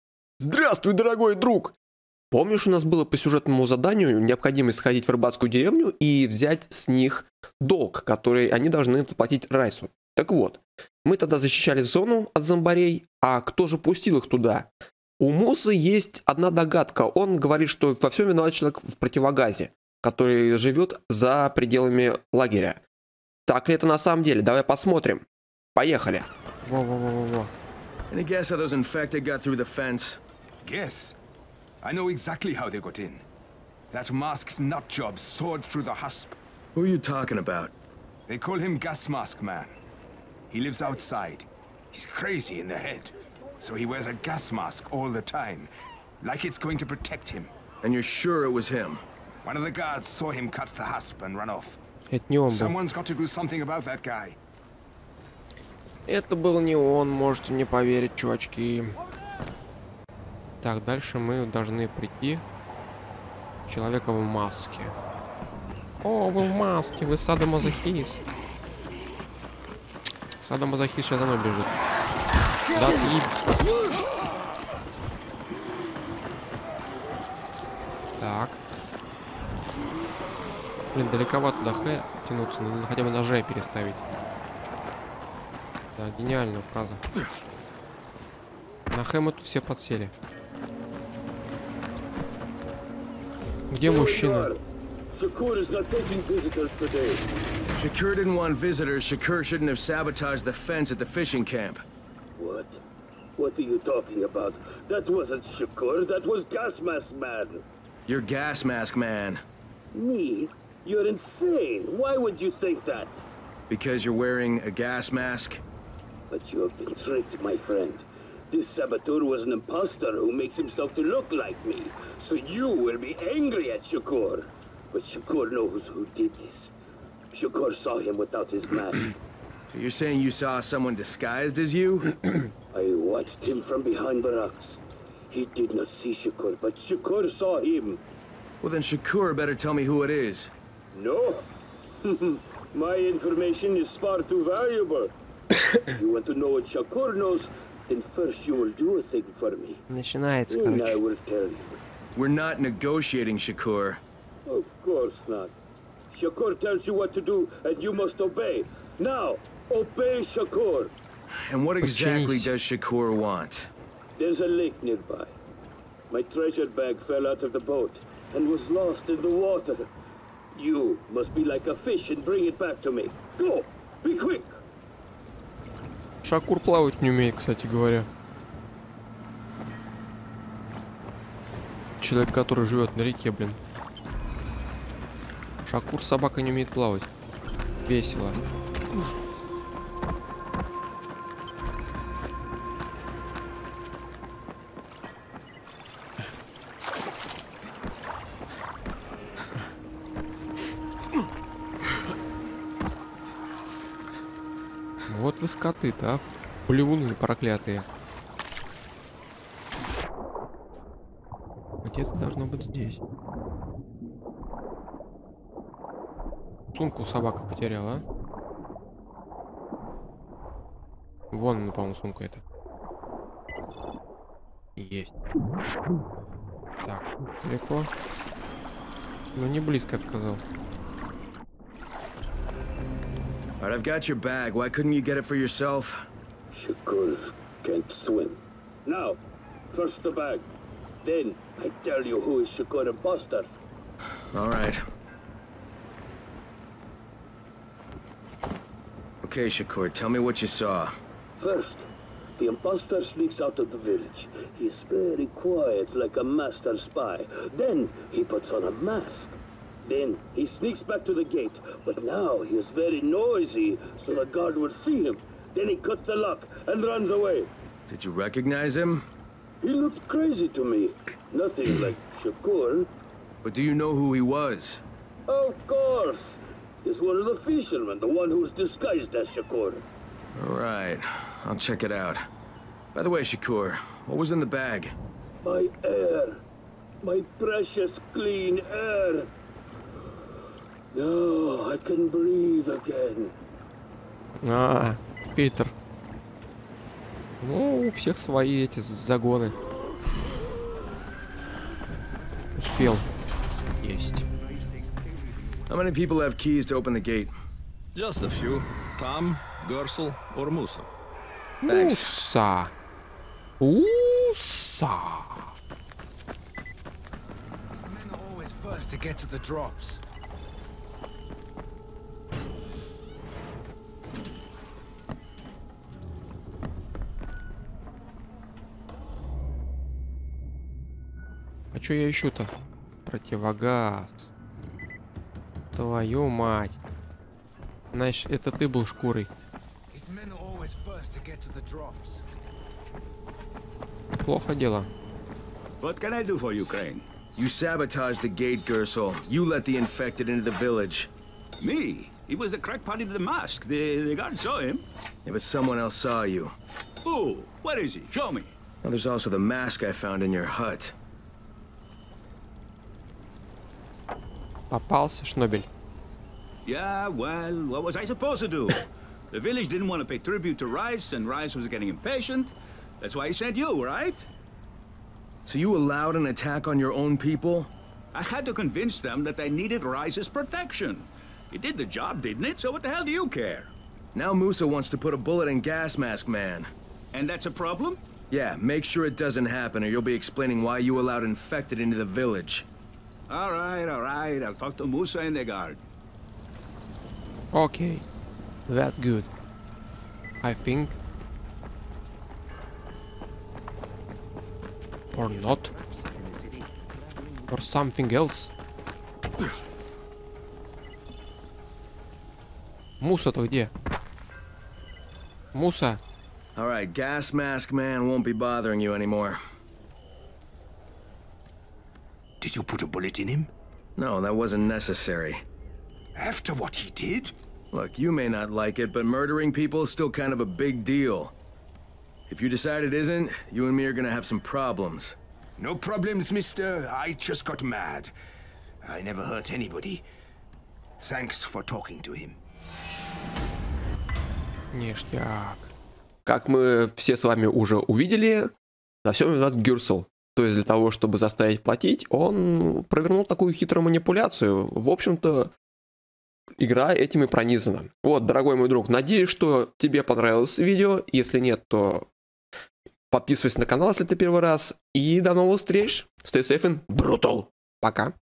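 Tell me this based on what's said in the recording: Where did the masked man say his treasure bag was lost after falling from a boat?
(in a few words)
a lake.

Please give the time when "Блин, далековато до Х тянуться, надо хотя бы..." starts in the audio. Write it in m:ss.
1:20.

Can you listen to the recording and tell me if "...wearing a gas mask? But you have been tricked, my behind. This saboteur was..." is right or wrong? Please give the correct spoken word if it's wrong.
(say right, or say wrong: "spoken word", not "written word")
wrong: "friend", not "behind".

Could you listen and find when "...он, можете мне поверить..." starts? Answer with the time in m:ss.
0:56.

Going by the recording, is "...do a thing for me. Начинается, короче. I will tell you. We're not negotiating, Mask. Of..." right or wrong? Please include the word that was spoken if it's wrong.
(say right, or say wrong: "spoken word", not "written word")
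wrong: "Shakur", not "Mask".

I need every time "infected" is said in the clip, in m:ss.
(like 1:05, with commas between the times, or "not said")
5:49, 6:31.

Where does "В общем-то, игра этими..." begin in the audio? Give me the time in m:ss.
7:34.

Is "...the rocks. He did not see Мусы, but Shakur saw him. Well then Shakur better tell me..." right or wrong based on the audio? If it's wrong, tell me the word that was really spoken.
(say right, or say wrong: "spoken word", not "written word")
wrong: "Shakur", not "Мусы".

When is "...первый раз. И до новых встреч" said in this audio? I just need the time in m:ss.
7:44.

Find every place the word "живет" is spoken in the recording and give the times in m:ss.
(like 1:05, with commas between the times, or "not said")
0:20, 3:02.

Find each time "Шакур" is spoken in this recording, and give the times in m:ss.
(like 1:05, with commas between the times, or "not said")
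2:56, 3:05.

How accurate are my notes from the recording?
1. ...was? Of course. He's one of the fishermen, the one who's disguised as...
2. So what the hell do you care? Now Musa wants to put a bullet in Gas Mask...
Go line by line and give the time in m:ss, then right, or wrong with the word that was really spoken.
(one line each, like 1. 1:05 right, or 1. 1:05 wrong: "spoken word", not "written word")
1. 4:34 right
2. 6:22 right.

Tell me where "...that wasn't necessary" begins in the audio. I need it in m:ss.
7:04.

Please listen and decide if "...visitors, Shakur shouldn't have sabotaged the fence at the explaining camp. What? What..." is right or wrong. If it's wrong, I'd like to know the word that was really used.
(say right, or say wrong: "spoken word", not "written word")
wrong: "fishing", not "explaining".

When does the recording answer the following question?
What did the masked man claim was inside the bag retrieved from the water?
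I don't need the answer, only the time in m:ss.
4:47.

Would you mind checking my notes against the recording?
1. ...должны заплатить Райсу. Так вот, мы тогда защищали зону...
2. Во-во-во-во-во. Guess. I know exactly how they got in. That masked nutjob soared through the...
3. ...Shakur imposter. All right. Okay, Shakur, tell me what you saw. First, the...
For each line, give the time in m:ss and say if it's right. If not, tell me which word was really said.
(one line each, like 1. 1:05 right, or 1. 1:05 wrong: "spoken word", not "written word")
1. 0:08 right
2. 0:26 right
3. 4:02 right.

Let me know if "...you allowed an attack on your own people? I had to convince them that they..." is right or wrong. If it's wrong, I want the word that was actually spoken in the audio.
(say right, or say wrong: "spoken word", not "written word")
right.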